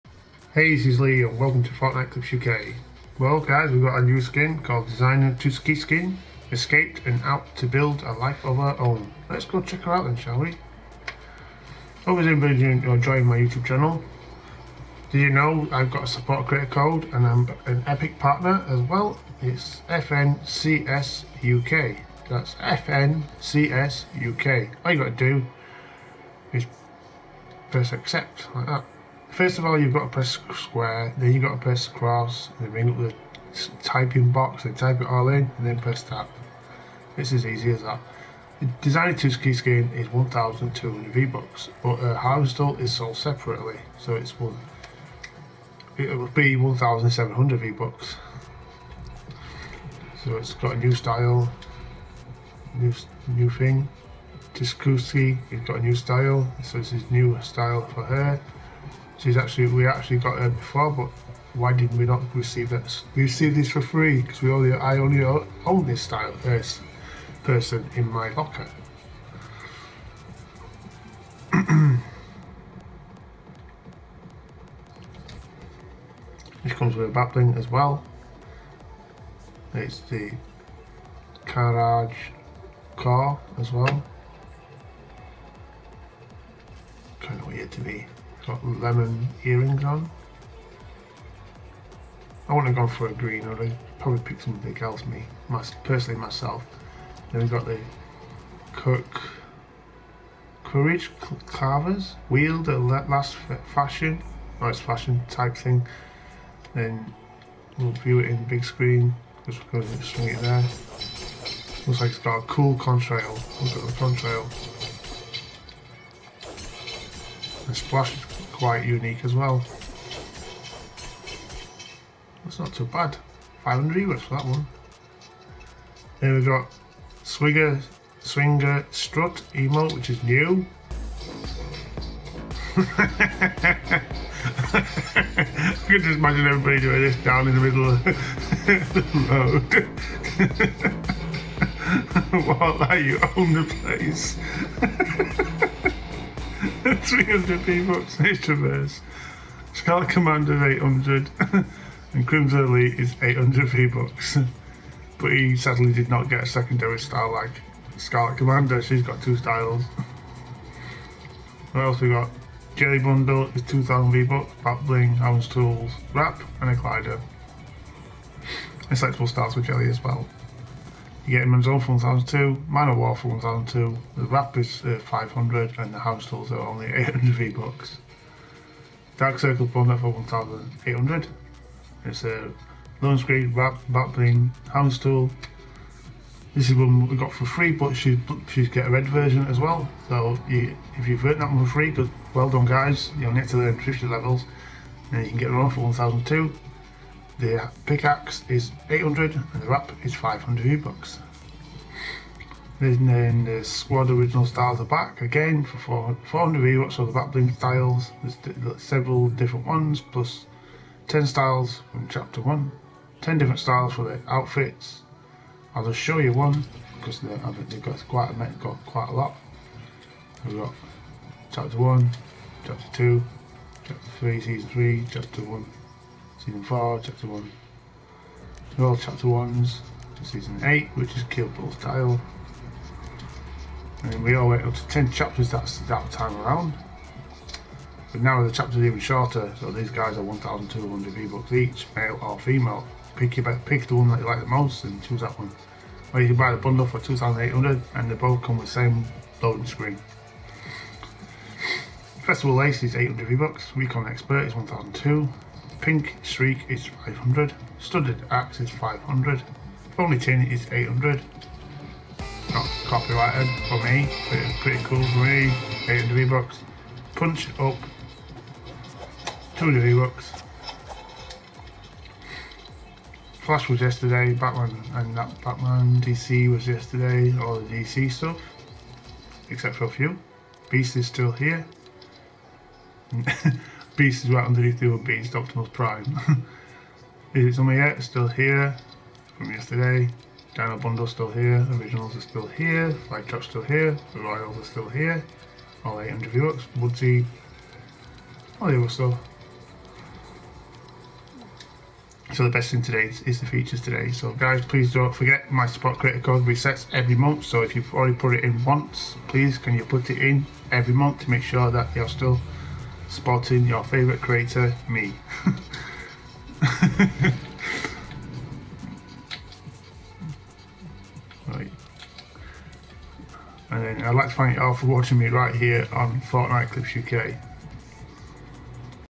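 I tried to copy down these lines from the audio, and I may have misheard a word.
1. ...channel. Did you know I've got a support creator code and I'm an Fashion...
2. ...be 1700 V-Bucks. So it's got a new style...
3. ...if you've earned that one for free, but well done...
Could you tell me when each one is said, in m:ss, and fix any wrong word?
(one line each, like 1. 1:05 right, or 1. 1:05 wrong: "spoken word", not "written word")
1. 0:13 wrong: "Epic", not "Fashion"
2. 0:46 right
3. 3:10 right.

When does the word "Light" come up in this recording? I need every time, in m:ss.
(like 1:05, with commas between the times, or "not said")
4:53.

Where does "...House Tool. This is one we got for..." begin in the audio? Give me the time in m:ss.
3:04.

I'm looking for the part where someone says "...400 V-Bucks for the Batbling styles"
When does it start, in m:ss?
3:25.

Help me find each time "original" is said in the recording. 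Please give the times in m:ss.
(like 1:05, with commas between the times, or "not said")
3:24, 4:51.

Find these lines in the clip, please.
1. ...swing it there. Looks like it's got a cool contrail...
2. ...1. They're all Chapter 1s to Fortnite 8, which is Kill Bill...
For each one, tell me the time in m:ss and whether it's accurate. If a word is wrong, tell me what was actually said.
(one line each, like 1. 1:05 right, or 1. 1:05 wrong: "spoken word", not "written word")
1. 1:50 right
2. 3:47 wrong: "Season", not "Fortnite".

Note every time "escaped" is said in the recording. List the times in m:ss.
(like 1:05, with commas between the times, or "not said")
0:06.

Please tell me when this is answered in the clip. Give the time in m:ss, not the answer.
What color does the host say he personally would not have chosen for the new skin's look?
1:33.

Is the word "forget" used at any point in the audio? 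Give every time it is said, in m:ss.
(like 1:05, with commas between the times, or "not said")
5:05.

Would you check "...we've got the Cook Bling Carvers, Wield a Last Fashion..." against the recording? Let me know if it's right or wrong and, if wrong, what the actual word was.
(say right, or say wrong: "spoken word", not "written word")
wrong: "Courage", not "Bling".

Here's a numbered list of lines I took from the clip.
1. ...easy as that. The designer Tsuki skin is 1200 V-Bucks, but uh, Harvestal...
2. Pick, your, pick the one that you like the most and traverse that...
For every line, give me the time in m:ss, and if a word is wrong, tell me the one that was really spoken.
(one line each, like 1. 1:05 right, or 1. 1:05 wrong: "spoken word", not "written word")
1. 0:37 right
2. 4:03 wrong: "choose", not "traverse".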